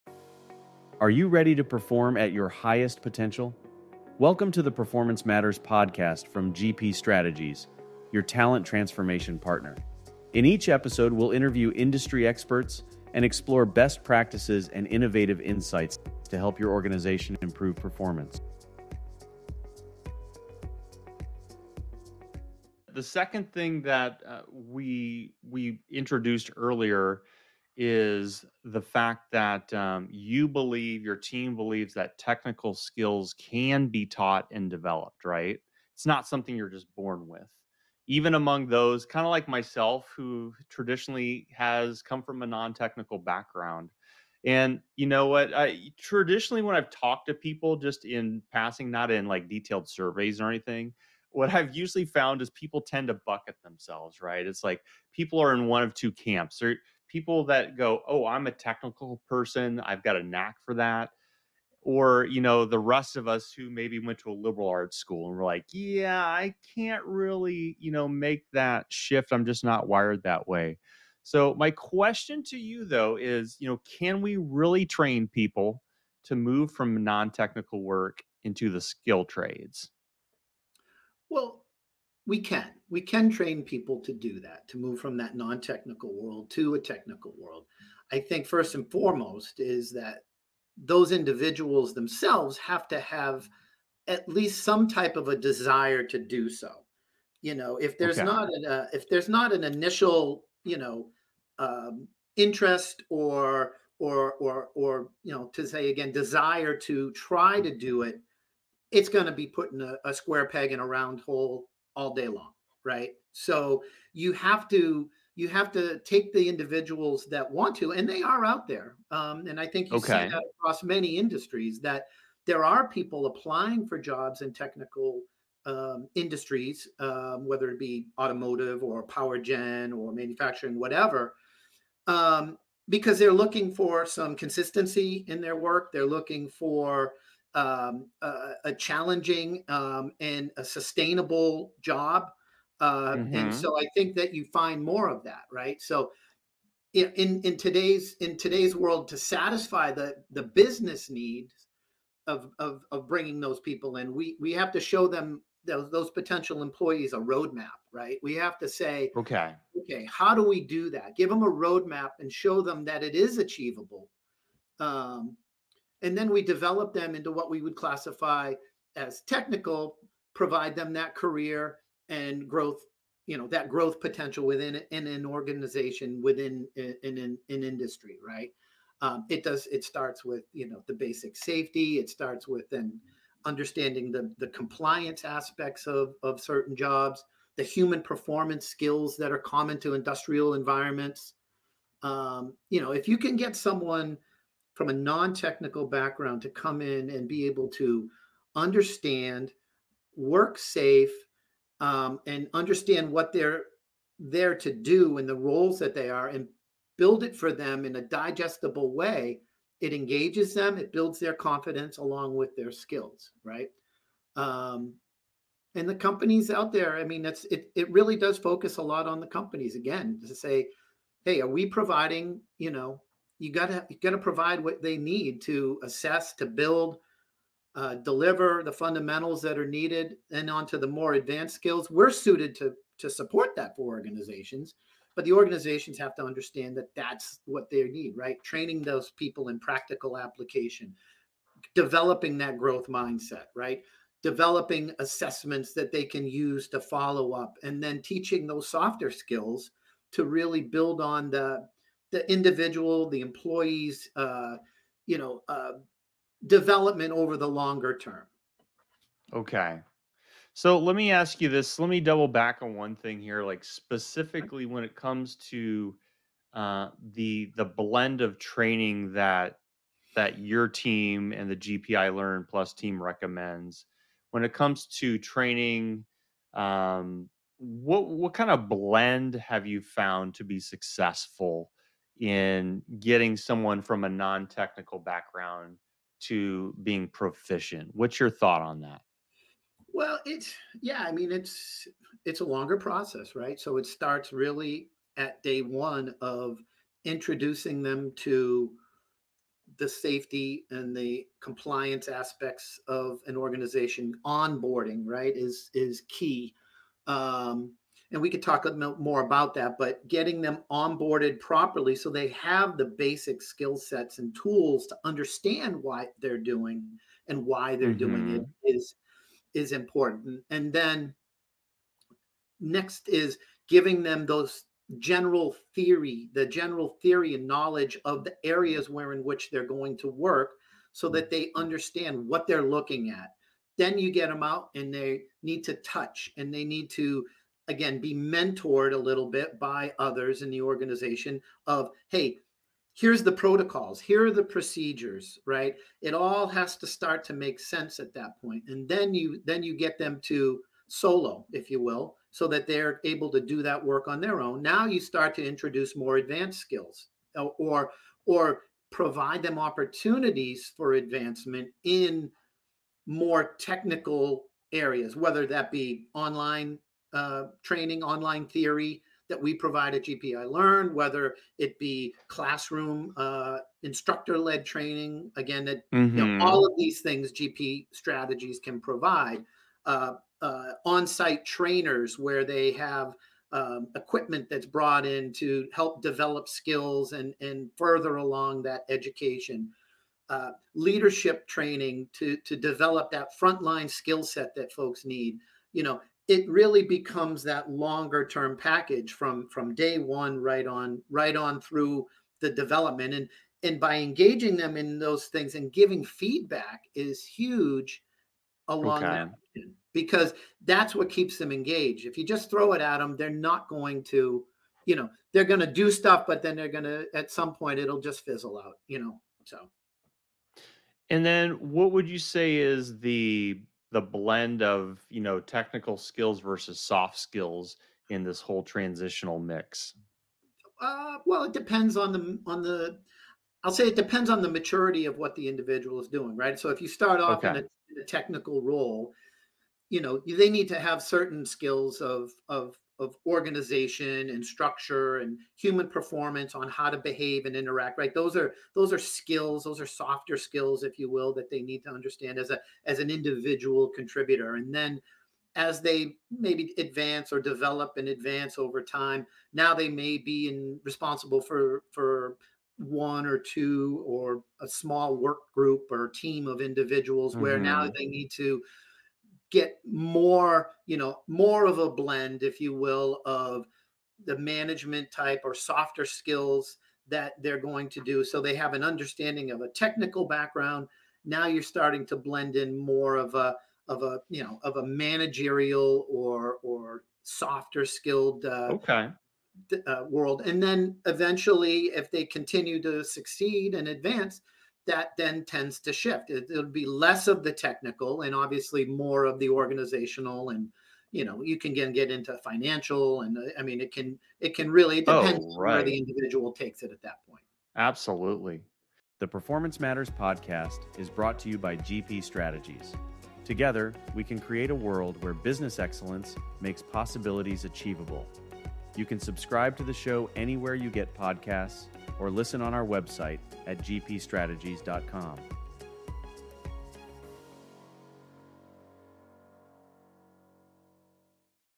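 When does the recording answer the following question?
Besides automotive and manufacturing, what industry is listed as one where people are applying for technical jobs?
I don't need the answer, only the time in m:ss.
2:09.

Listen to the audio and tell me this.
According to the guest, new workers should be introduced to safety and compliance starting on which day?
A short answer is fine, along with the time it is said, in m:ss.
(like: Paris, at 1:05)
day 1, at 4:55.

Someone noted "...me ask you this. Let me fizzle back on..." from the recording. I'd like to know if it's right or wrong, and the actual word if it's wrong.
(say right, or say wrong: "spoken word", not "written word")
wrong: "double", not "fizzle".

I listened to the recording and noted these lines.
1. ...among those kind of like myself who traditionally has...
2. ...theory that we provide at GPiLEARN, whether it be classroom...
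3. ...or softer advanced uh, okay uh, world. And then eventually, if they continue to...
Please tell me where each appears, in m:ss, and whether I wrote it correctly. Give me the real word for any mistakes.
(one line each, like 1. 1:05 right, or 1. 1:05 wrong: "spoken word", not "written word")
1. 0:38 right
2. 6:08 right
3. 8:06 wrong: "skilled", not "advanced".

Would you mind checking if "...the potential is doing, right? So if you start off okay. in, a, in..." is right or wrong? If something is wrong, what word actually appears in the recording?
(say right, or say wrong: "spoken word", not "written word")
wrong: "individual", not "potential".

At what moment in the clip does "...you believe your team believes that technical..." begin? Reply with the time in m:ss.
0:30.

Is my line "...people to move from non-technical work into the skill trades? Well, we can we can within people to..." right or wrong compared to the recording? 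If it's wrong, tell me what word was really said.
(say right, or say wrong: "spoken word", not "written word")
wrong: "train", not "within".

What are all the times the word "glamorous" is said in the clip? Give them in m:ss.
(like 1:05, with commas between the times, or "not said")
not said.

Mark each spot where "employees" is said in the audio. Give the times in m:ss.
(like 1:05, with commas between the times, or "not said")
2:36, 4:13.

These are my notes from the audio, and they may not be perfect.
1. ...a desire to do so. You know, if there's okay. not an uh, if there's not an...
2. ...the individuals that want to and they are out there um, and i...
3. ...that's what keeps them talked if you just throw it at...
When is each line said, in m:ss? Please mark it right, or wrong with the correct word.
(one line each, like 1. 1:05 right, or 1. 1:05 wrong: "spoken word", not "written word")
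1. 1:35 right
2. 1:56 right
3. 6:50 wrong: "engaged", not "talked".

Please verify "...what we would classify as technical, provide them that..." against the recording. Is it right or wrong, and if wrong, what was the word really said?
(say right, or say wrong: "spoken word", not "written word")
right.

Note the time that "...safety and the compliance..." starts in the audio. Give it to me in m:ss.
4:59.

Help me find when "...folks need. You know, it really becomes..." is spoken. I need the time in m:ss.
6:34.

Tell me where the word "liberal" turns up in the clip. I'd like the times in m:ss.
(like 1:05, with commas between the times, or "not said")
1:04.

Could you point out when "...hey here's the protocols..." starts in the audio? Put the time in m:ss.
5:42.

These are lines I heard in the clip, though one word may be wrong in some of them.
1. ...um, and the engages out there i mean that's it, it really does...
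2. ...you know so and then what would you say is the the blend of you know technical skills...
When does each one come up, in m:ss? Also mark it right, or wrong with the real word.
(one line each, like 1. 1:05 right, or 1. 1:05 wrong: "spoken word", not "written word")
1. 3:34 wrong: "companies", not "engages"
2. 6:58 right.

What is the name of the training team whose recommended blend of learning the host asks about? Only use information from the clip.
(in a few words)
GPiLEARN Plus.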